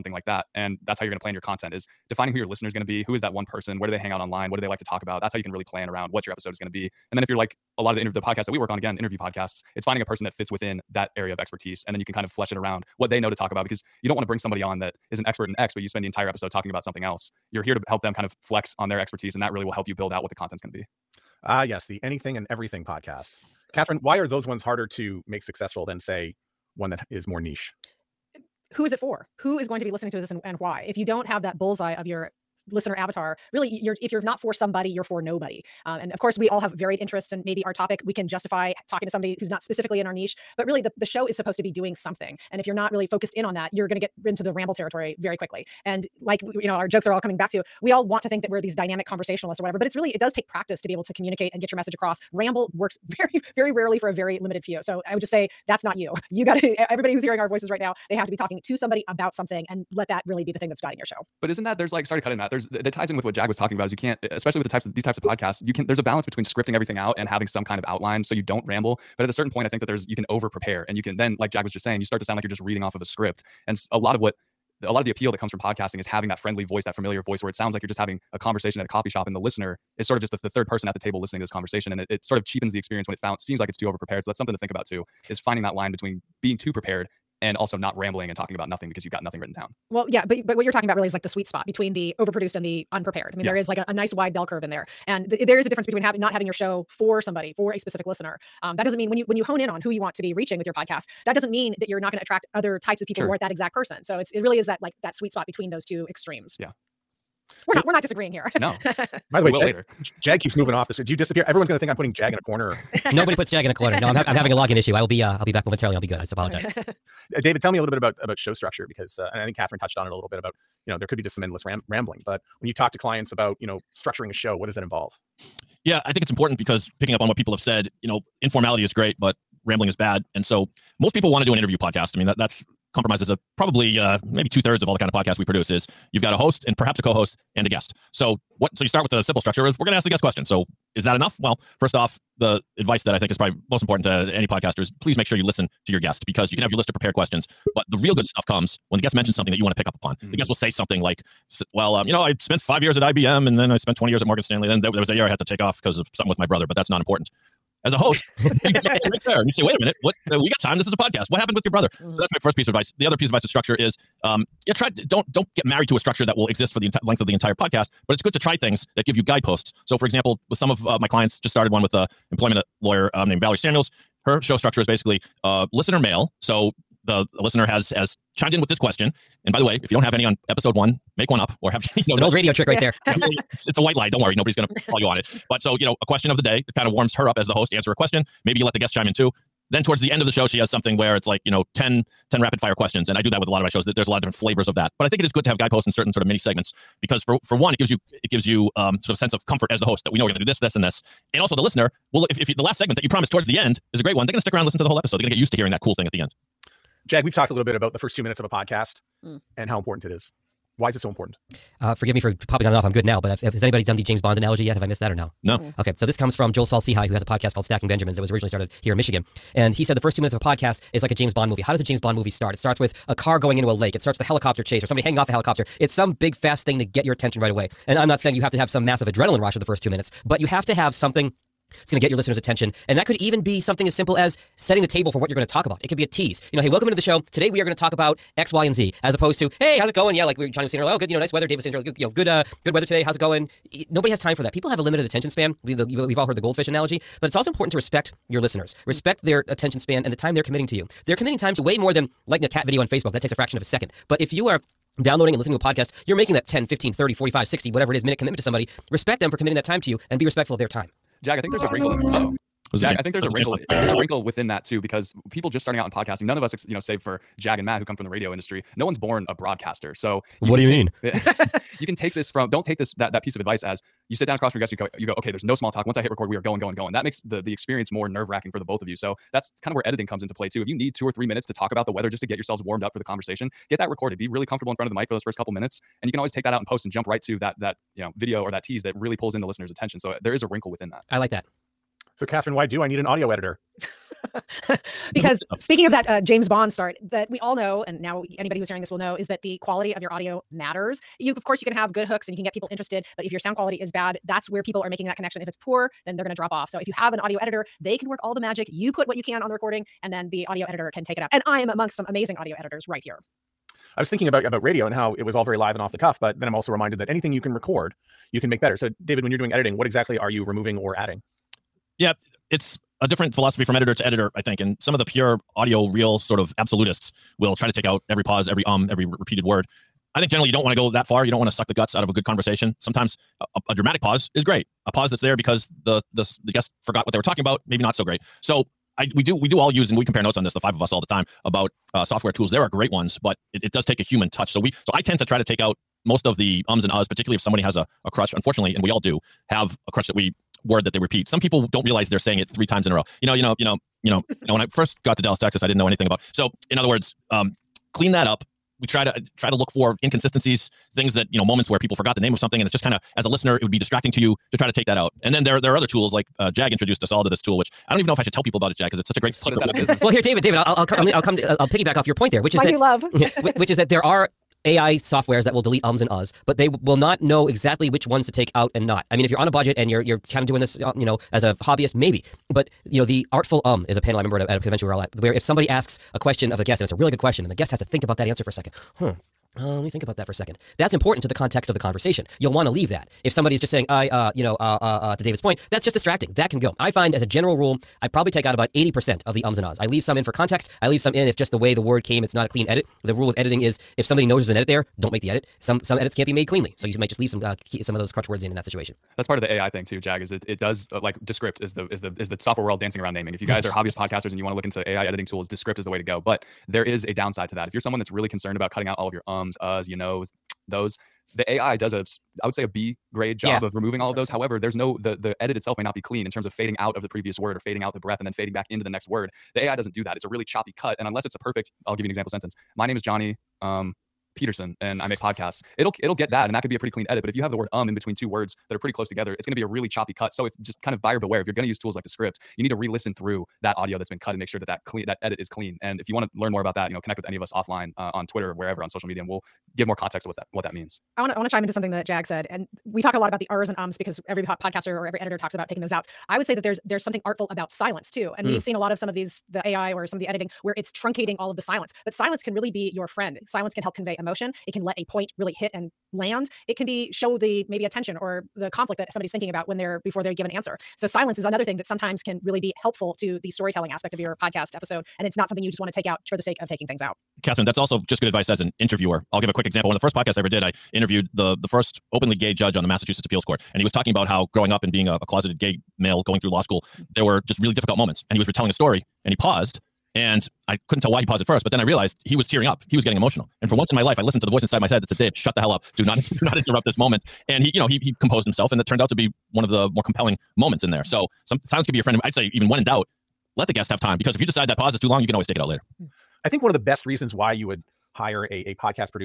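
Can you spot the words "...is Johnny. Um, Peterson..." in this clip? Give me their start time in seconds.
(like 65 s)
432 s.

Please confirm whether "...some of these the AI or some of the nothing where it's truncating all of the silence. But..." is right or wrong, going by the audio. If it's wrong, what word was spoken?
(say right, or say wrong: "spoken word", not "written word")
wrong: "editing", not "nothing".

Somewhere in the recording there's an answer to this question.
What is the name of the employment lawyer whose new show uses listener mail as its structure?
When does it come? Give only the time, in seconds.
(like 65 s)
173 s.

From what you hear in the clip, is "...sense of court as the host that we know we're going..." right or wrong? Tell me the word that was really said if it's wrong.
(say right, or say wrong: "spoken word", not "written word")
wrong: "comfort", not "court".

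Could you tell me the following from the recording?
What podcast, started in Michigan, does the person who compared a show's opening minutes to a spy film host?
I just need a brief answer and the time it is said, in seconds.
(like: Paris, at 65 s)
Stacking Benjamins, at 217 s.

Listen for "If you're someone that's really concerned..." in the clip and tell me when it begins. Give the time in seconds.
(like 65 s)
417 s.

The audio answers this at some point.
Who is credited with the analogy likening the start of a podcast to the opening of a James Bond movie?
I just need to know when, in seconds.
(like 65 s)
216 s.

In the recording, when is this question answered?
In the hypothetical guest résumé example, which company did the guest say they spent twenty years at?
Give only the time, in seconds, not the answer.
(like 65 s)
154 s.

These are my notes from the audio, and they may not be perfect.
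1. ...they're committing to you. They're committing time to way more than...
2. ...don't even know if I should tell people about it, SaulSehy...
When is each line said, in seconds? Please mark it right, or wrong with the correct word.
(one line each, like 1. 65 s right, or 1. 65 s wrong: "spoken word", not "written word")
1. 250 s right
2. 367 s wrong: "Jag", not "SaulSehy".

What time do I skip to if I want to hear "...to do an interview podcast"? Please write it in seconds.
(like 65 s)
131 s.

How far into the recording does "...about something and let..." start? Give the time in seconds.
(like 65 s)
59 s.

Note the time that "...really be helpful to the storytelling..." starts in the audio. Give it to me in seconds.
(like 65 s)
472 s.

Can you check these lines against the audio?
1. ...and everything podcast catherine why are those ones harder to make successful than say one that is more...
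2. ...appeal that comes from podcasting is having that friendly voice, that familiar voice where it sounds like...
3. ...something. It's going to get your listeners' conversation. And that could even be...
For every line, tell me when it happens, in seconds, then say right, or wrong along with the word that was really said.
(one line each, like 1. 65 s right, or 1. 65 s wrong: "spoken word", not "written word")
1. 22 s right
2. 75 s right
3. 230 s wrong: "attention", not "conversation".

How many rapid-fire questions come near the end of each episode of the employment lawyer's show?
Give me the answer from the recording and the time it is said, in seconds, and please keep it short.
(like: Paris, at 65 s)
10, at 191 s.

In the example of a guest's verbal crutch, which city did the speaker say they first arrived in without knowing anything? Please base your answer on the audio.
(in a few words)
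Dallas, Texas.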